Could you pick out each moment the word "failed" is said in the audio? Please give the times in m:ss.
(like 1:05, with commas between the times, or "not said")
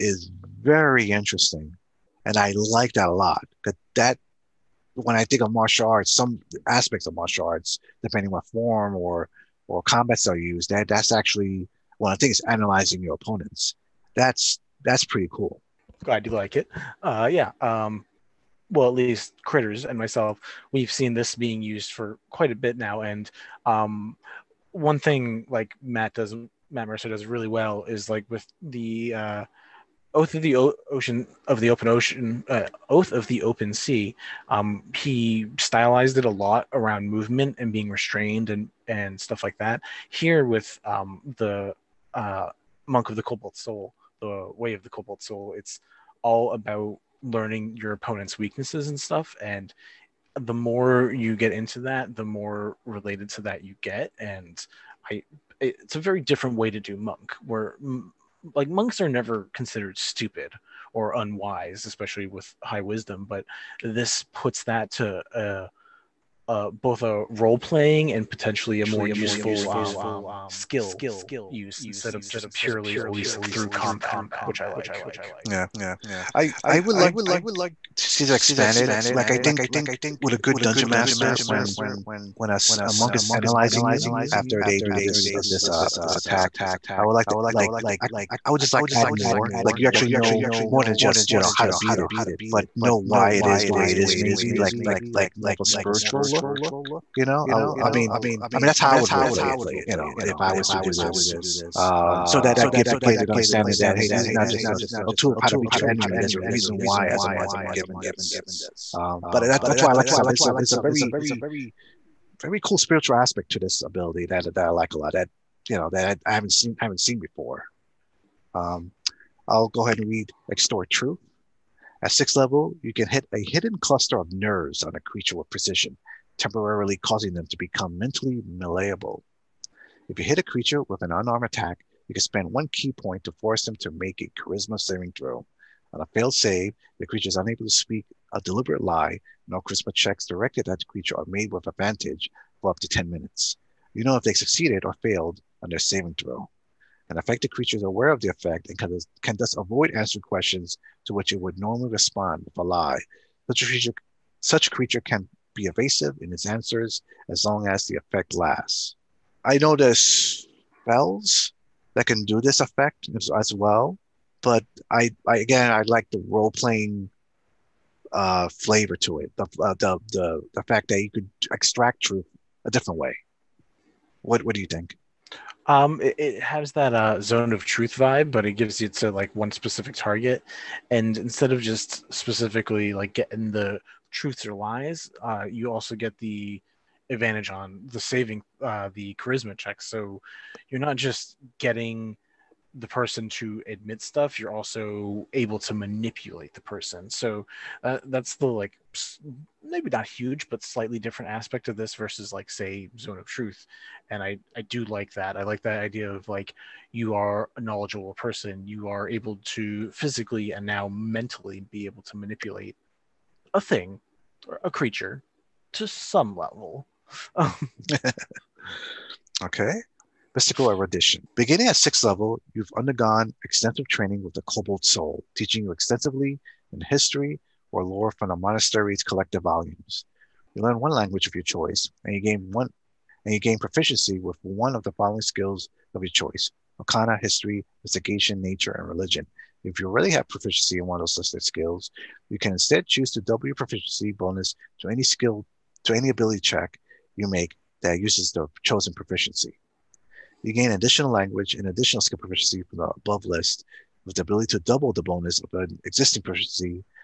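2:16, 2:25.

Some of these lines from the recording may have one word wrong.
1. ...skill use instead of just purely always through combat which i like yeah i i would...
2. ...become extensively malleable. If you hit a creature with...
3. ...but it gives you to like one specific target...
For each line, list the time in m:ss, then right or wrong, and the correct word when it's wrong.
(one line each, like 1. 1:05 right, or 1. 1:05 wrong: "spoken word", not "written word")
1. 1:10 right
2. 2:07 wrong: "mentally", not "extensively"
3. 2:58 right.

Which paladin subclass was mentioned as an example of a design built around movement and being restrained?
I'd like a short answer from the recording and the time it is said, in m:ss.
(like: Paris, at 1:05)
Oath of the Open Sea, at 0:32.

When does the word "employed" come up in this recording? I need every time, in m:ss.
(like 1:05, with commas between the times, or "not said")
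not said.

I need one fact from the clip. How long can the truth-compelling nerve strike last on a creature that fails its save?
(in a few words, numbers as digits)
10 minutes.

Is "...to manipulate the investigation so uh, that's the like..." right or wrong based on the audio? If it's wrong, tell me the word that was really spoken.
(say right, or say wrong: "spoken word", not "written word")
wrong: "person", not "investigation".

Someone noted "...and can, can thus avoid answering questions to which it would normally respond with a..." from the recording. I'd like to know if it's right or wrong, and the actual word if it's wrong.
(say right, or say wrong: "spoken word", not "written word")
right.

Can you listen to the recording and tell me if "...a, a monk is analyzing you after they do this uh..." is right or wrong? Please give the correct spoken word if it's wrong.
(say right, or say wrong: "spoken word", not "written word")
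right.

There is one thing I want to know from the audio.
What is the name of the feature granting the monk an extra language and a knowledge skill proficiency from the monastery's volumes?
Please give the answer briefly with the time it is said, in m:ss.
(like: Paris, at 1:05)
Mystical Erudition, at 3:40.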